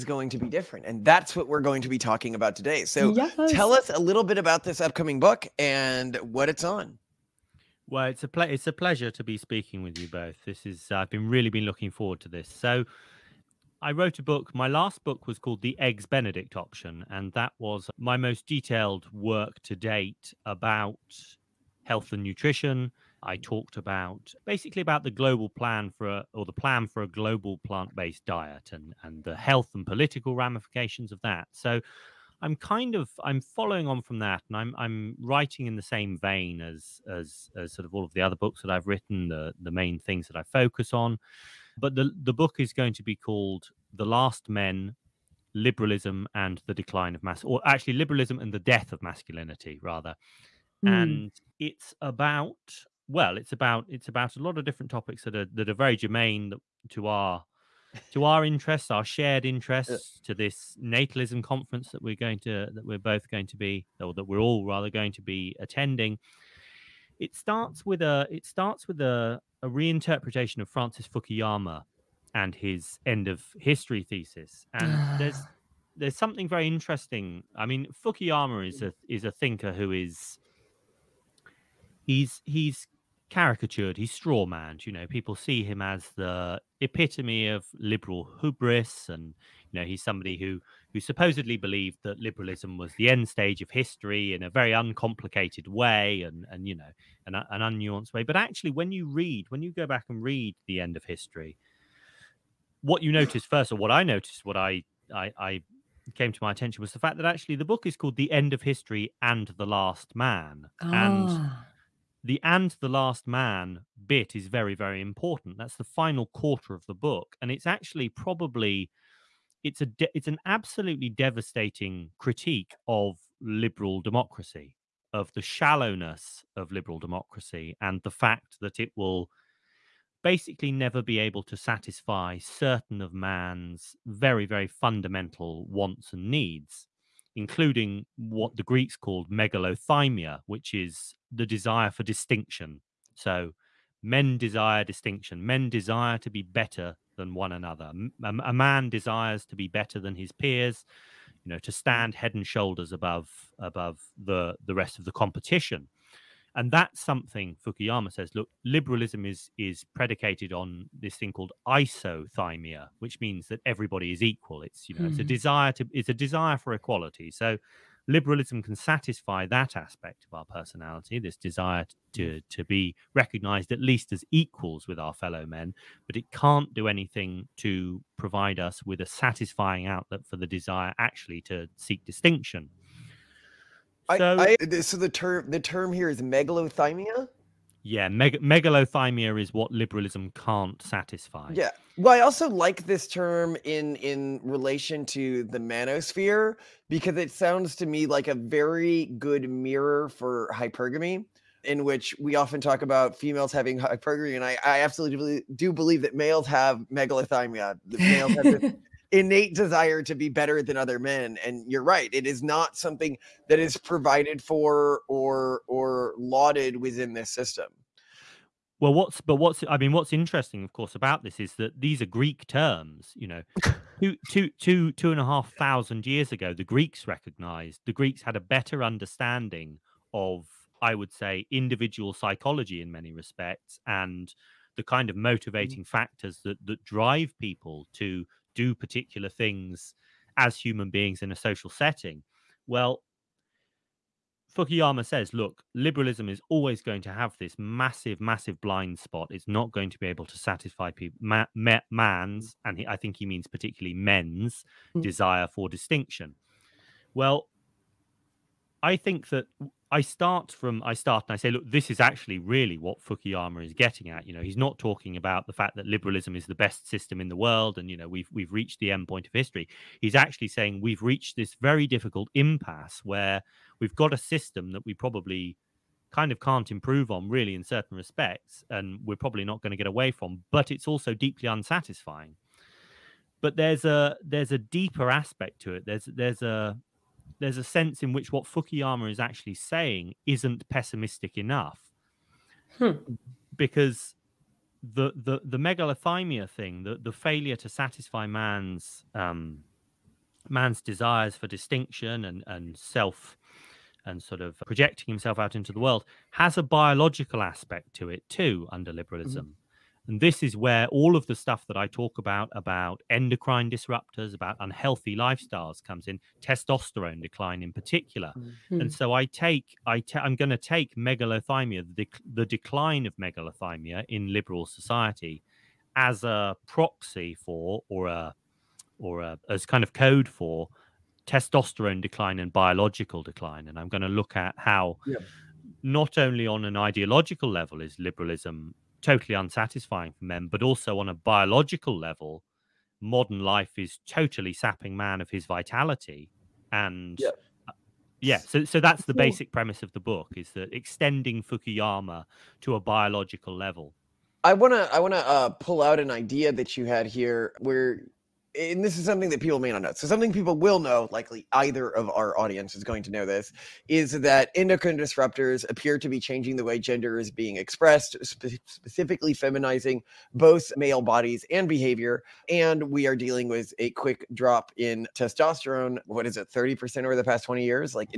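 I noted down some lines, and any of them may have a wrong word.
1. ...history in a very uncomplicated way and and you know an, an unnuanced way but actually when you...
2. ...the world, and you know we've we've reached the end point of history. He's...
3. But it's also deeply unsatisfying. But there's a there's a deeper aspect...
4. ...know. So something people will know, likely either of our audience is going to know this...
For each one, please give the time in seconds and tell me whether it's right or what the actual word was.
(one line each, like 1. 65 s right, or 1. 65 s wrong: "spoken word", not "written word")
1. 93 s right
2. 267 s right
3. 280 s right
4. 359 s right.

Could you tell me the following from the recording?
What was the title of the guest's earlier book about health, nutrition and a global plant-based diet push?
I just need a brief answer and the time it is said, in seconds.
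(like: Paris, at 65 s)
The Eggs Benedict Option, at 15 s.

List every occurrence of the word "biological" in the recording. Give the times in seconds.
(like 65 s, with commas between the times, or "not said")
306 s, 332 s, 341 s, 352 s.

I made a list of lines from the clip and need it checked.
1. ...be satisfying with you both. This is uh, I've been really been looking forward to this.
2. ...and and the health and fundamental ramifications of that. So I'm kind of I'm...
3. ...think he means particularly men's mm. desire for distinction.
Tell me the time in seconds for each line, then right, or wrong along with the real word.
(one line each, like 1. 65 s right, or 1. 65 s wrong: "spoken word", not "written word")
1. 9 s wrong: "speaking", not "satisfying"
2. 28 s wrong: "political", not "fundamental"
3. 252 s right.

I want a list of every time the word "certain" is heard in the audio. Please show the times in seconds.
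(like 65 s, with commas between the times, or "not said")
132 s, 277 s.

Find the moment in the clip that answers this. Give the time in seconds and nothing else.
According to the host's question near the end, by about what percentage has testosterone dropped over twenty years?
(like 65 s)
376 s.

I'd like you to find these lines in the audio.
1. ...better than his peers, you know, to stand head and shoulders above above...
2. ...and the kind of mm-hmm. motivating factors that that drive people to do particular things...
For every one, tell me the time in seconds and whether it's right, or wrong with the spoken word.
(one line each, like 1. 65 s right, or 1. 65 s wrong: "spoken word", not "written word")
1. 149 s right
2. 233 s right.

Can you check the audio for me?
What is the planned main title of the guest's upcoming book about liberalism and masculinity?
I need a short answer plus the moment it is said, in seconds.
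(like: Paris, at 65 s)
The Last Men, at 43 s.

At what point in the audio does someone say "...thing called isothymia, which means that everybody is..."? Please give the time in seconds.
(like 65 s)
161 s.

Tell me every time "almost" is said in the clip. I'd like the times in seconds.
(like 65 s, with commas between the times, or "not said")
not said.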